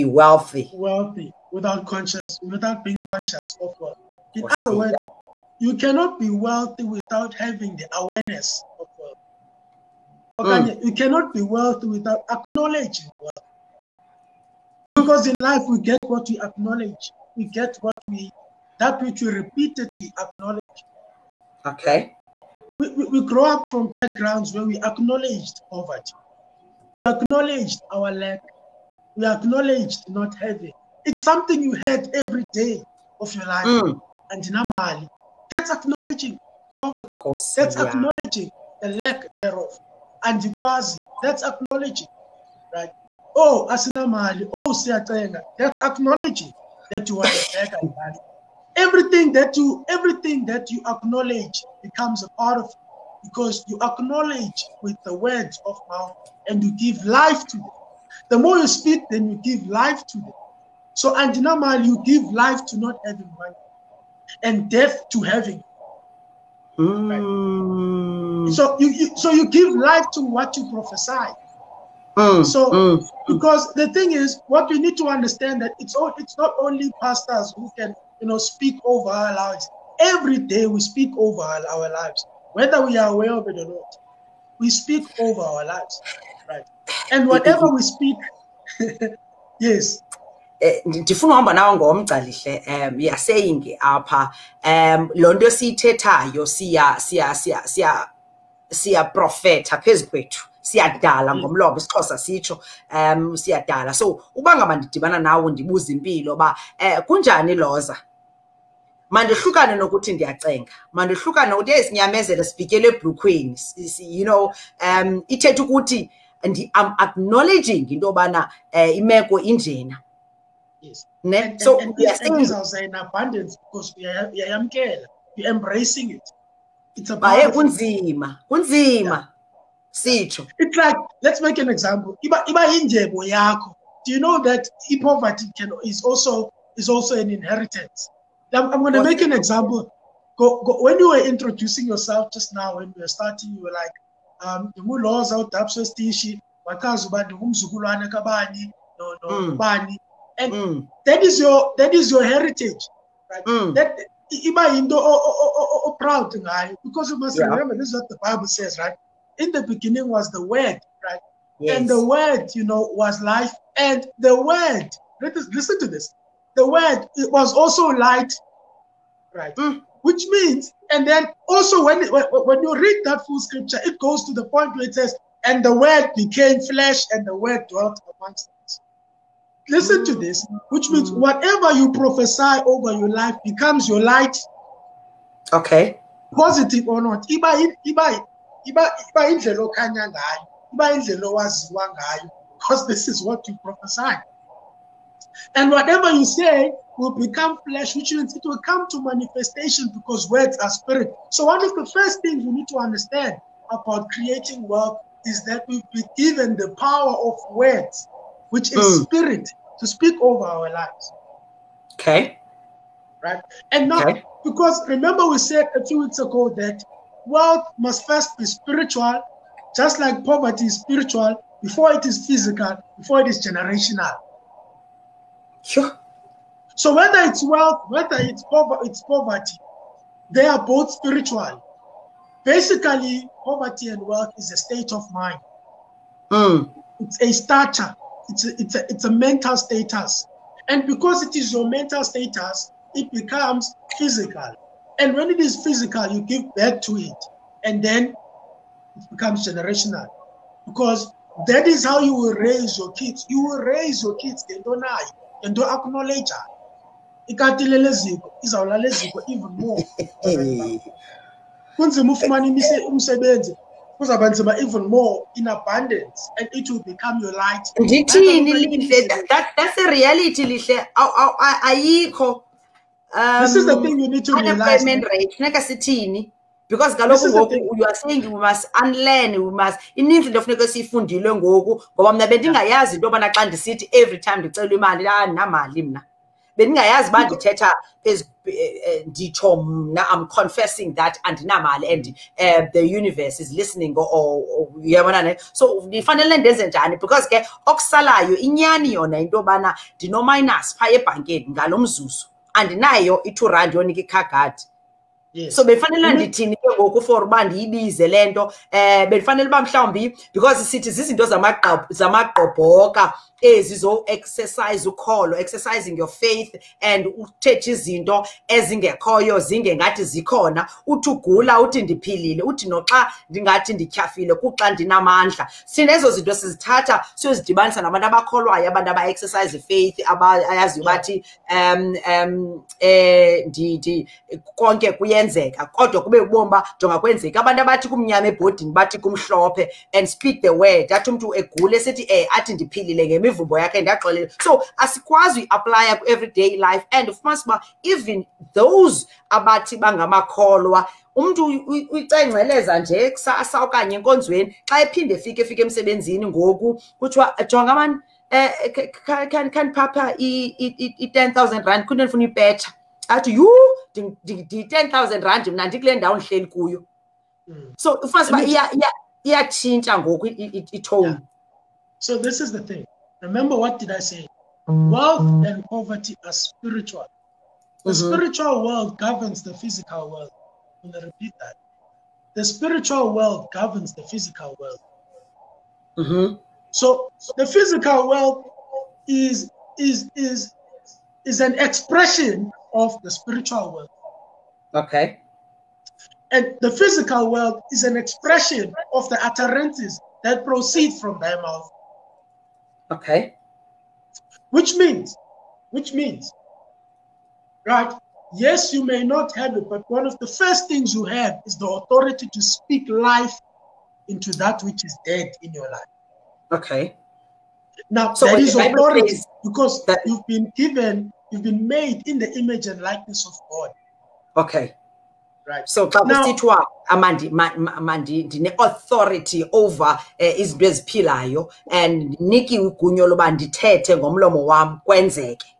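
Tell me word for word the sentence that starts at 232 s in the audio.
Basically, poverty and wealth is a state of mind.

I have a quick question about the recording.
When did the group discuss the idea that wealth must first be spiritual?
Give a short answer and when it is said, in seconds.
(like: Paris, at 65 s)
a few weeks ago, at 215 s.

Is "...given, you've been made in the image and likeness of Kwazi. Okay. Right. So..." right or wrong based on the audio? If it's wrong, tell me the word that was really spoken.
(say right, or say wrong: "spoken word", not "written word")
wrong: "God", not "Kwazi".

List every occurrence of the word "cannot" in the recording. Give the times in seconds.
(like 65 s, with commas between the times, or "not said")
5 s, 10 s.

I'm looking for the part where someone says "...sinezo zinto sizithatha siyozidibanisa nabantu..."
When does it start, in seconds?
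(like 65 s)
325 s.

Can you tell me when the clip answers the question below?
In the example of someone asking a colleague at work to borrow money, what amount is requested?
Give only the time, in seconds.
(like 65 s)
361 s.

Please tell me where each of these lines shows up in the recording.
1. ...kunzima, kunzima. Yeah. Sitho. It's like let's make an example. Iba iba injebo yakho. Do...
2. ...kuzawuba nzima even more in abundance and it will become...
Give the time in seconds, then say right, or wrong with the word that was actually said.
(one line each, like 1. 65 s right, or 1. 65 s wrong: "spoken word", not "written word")
1. 127 s right
2. 263 s right.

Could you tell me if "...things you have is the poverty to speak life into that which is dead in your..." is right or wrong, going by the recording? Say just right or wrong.
wrong.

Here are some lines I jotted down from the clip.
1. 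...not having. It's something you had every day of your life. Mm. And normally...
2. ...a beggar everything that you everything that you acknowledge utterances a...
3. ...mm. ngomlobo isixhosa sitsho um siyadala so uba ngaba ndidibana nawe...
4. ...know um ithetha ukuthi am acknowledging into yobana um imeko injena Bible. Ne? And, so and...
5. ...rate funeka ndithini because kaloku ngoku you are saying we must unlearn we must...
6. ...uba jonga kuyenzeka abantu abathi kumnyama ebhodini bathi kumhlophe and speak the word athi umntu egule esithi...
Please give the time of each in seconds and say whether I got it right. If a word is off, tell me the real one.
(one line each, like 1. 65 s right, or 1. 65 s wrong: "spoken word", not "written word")
1. 30 s right
2. 47 s wrong: "becomes", not "utterances"
3. 101 s right
4. 114 s wrong: "Yes", not "Bible"
5. 275 s wrong: "sithini", not "ndithini"
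6. 336 s wrong: "kwenzeka", not "kuyenzeka".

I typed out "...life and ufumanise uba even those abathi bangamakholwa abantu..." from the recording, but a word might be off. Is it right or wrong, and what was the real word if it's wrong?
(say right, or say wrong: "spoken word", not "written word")
wrong: "umntu", not "abantu".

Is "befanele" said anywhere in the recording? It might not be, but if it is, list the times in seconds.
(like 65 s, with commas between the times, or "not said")
305 s.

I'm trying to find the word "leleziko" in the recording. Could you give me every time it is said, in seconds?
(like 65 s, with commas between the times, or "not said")
257 s.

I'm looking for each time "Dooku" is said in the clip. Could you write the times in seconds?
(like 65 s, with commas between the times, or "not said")
not said.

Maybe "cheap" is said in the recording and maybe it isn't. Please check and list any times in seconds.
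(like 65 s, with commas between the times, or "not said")
not said.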